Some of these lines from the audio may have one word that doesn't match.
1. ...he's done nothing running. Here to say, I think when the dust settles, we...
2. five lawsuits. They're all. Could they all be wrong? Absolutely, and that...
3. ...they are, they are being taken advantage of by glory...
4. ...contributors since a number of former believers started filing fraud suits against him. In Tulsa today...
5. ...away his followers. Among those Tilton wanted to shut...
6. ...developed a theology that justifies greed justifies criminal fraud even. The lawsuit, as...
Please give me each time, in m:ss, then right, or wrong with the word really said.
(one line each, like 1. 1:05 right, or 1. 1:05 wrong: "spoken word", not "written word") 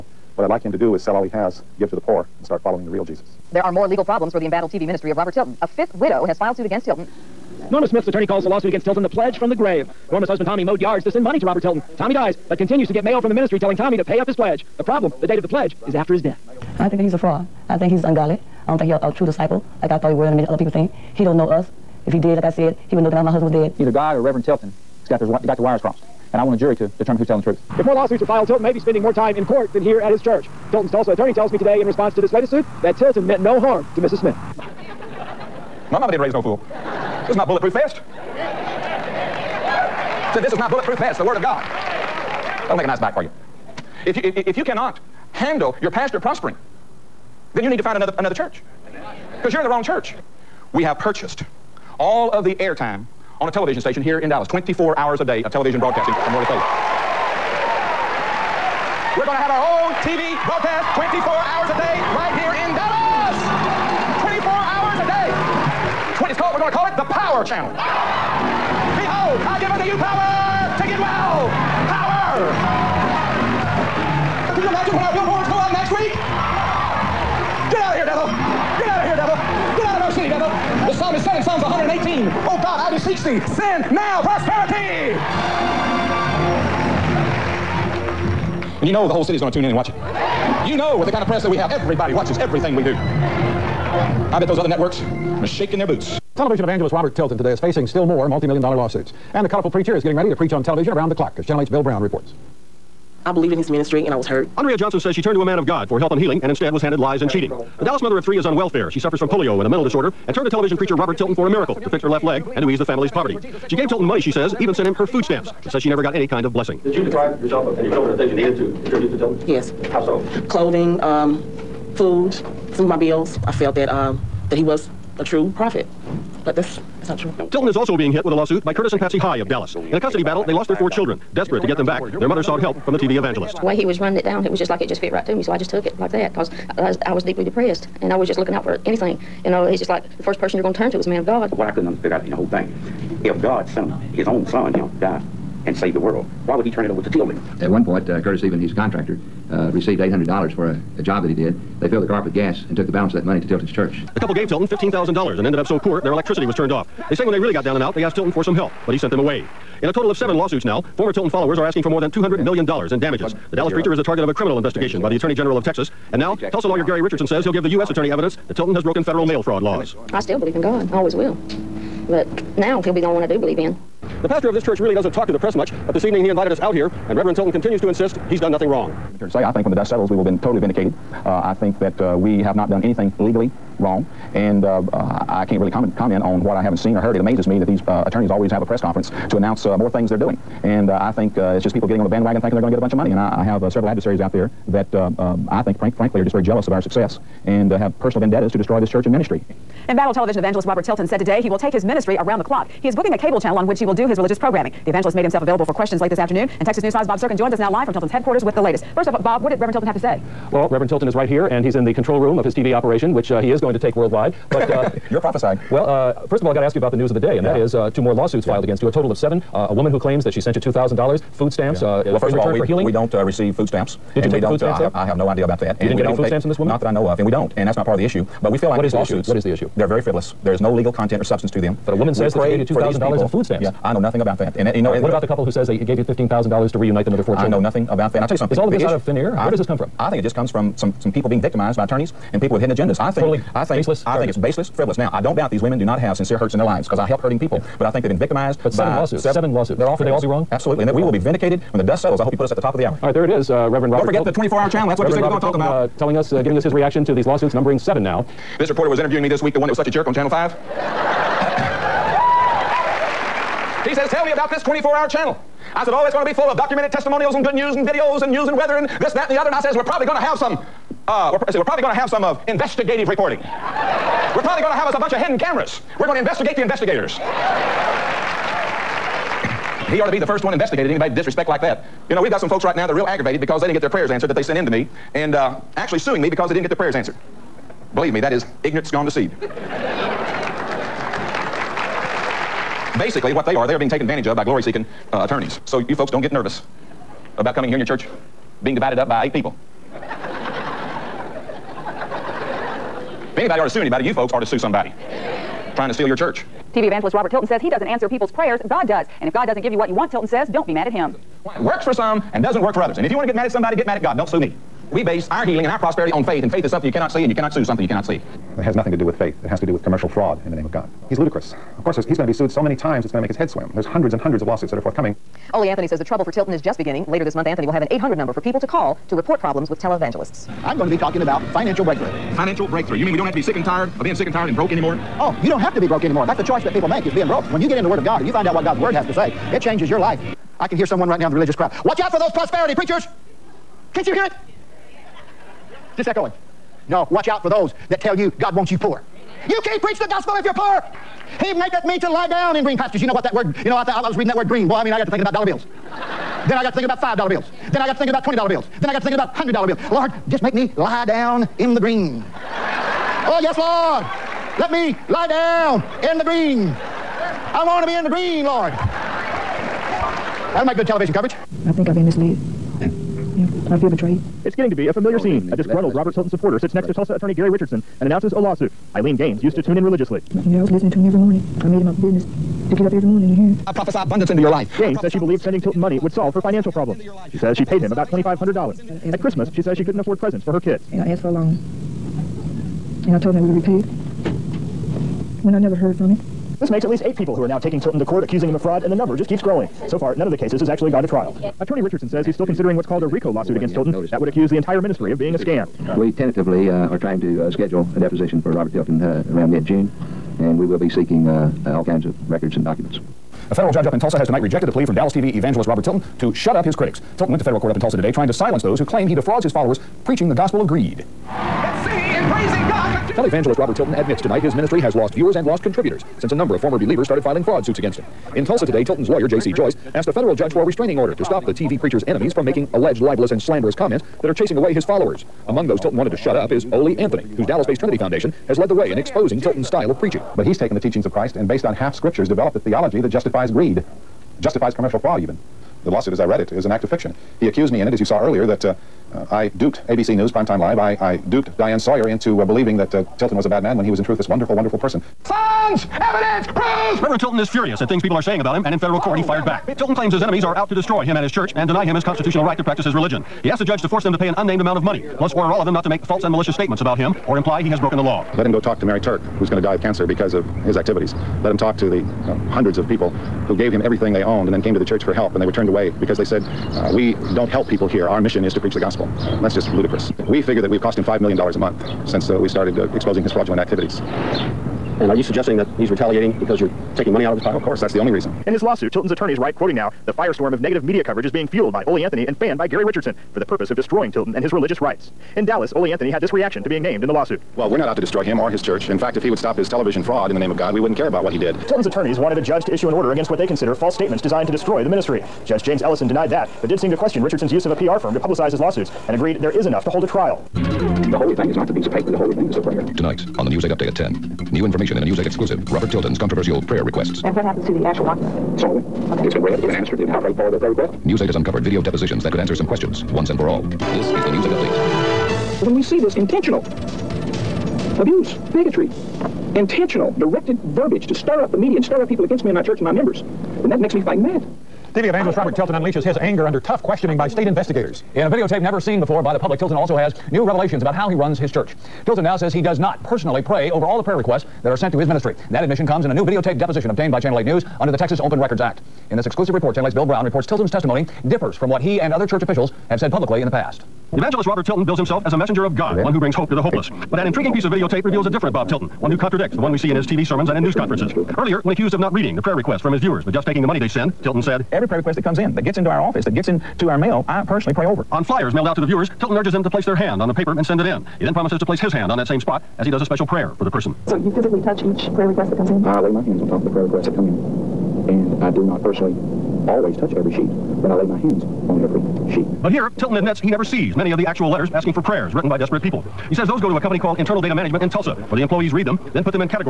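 1. 2:58 wrong: "wrong", not "running"
2. 4:09 wrong: "seven", not "five"
3. 4:53 right
4. 7:05 right
5. 7:14 right
6. 7:22 wrong: "commercial", not "criminal".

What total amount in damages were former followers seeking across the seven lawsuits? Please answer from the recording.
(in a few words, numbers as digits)
more than $200 million.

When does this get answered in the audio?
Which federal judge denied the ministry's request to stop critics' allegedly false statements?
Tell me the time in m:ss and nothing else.
8:25.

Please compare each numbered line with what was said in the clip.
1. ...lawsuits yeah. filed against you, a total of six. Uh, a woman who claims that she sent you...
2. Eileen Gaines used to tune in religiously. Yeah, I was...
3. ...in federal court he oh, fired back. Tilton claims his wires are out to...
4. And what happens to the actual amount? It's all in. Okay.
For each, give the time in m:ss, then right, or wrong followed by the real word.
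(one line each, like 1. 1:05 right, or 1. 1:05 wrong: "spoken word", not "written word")
1. 3:38 wrong: "seven", not "six"
2. 6:18 right
3. 7:38 wrong: "enemies", not "wires"
4. 8:37 wrong: "document", not "amount".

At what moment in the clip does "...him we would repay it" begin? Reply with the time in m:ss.
6:33.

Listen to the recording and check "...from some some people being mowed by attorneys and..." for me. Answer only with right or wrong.
wrong.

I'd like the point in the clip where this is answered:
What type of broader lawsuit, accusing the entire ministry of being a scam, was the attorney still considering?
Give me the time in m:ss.
6:43.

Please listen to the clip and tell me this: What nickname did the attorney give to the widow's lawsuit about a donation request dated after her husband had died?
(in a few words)
the pledge from the grave.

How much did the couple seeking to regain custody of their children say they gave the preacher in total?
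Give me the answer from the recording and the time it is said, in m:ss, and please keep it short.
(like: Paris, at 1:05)
$15,000, at 2:34.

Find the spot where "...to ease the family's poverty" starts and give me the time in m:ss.
1:52.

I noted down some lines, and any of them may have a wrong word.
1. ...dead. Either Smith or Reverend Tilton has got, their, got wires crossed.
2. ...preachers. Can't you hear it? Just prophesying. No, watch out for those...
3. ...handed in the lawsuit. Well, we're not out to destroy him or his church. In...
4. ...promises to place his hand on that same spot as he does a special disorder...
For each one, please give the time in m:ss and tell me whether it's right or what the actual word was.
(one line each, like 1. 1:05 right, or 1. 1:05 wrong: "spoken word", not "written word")
1. 0:23 wrong: "God", not "Smith"
2. 5:42 wrong: "echoing", not "prophesying"
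3. 8:16 wrong: "named", not "handed"
4. 9:31 wrong: "prayer", not "disorder".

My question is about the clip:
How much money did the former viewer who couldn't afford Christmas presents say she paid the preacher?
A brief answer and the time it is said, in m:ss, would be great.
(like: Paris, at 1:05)
about $2,500, at 6:27.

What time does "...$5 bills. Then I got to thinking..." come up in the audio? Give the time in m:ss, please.
5:57.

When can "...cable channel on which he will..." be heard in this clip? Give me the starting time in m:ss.
3:23.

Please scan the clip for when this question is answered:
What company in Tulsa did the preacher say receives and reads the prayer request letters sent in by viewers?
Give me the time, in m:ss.
9:47.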